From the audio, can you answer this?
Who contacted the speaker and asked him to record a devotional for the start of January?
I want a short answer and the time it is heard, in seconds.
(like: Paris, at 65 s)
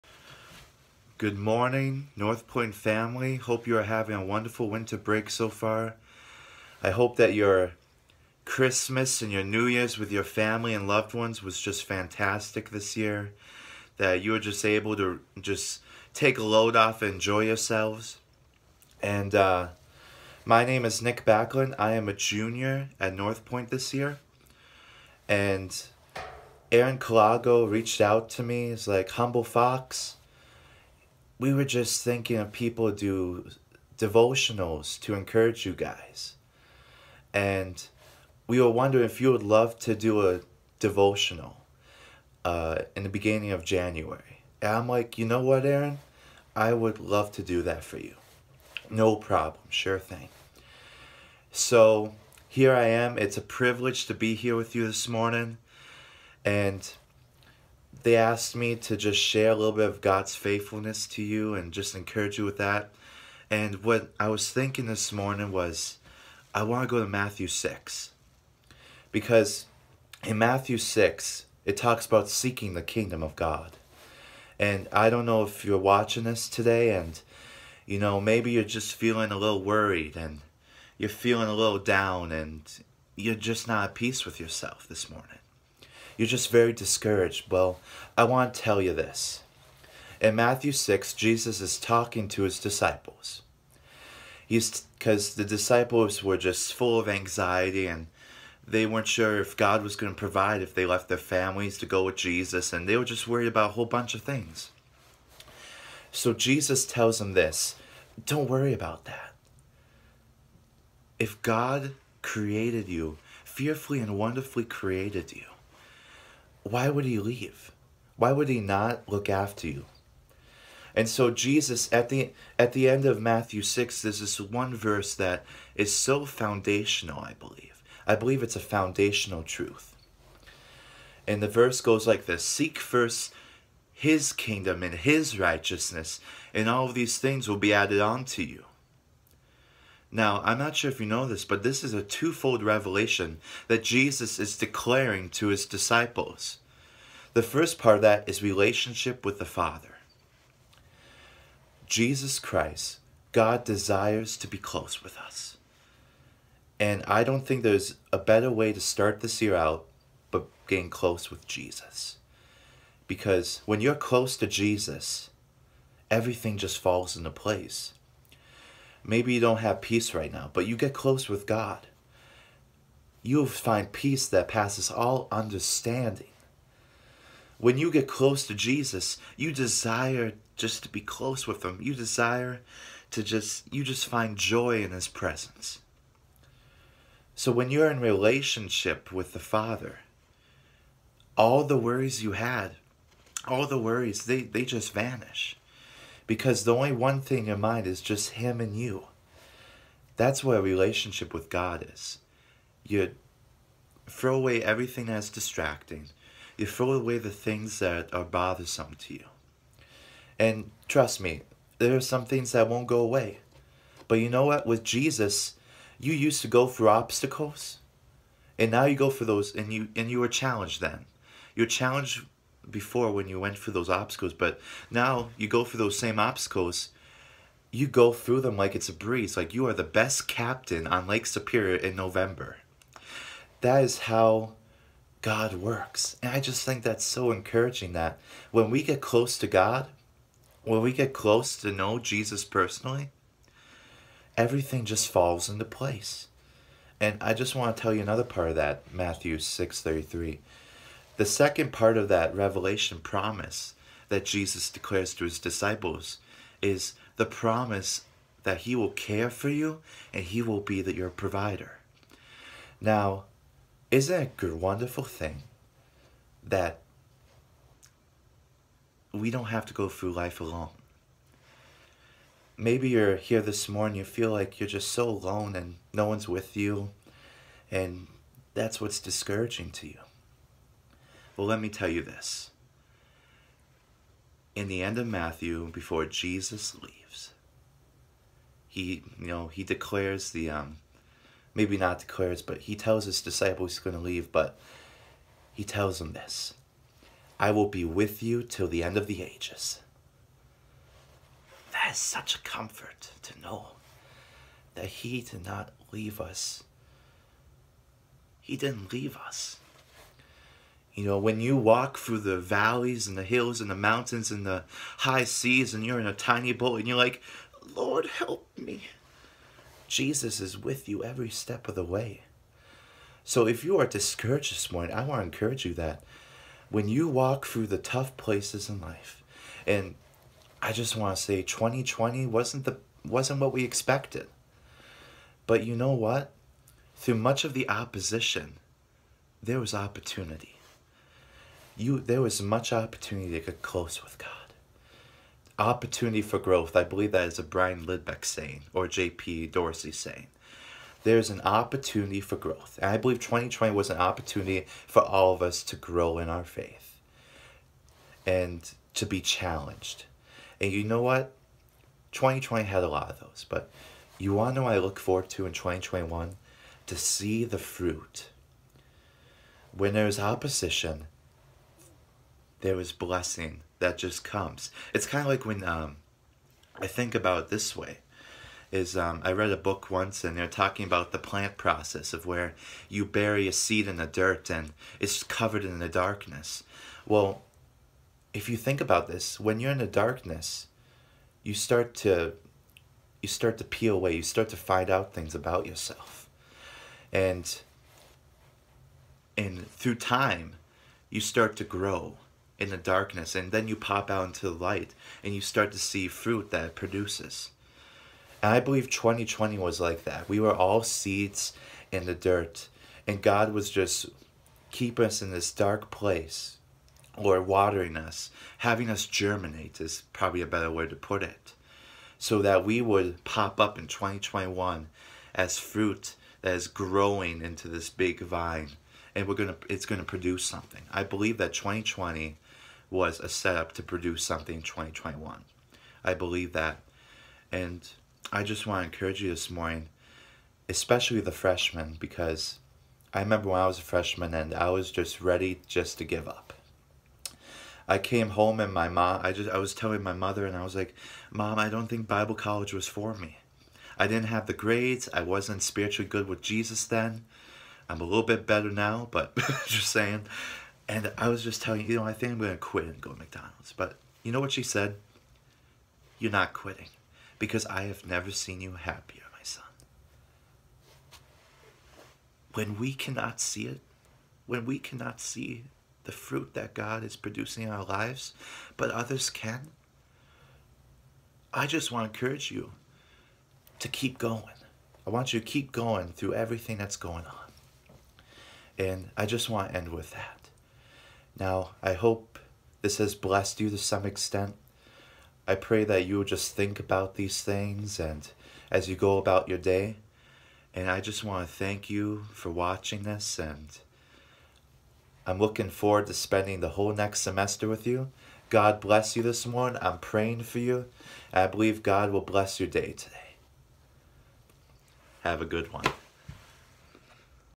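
Aaron Colago, at 26 s.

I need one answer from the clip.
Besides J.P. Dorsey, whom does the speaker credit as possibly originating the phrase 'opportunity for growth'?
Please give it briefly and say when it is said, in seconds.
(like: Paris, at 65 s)
Brian Lidbeck, at 347 s.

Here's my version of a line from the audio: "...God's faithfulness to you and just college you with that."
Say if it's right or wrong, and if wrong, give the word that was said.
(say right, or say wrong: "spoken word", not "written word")
wrong: "encourage", not "college".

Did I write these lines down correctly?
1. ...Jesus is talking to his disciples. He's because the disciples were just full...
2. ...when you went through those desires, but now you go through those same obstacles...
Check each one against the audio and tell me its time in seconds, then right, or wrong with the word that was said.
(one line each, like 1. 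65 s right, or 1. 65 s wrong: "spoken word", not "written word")
1. 91 s right
2. 223 s wrong: "obstacles", not "desires".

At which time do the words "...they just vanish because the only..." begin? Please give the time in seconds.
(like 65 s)
194 s.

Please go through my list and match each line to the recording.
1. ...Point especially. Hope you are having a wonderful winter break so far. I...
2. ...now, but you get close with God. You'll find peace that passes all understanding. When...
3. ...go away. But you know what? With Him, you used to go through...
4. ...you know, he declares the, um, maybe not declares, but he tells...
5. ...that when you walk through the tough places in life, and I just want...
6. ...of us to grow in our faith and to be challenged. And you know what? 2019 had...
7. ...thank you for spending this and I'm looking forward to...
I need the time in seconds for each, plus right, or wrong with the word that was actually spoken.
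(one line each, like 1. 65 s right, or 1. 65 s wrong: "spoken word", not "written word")
1. 2 s wrong: "family", not "especially"
2. 170 s right
3. 212 s wrong: "Jesus", not "Him"
4. 289 s right
5. 325 s right
6. 355 s wrong: "2020", not "2019"
7. 501 s wrong: "watching", not "spending".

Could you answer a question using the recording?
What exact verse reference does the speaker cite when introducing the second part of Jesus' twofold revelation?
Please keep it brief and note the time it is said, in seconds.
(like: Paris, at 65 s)
Matthew 6:33, at 248 s.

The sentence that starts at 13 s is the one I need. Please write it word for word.
That you were just able to just take a load off and enjoy yourselves.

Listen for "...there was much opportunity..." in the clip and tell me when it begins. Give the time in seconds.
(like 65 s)
341 s.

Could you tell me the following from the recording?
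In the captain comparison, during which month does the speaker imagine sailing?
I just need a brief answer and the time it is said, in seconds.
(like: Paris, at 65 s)
November, at 231 s.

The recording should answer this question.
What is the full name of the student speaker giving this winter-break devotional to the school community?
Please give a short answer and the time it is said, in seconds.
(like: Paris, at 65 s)
Nick Backlund, at 21 s.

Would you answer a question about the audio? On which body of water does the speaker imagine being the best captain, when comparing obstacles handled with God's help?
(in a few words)
Lake Superior.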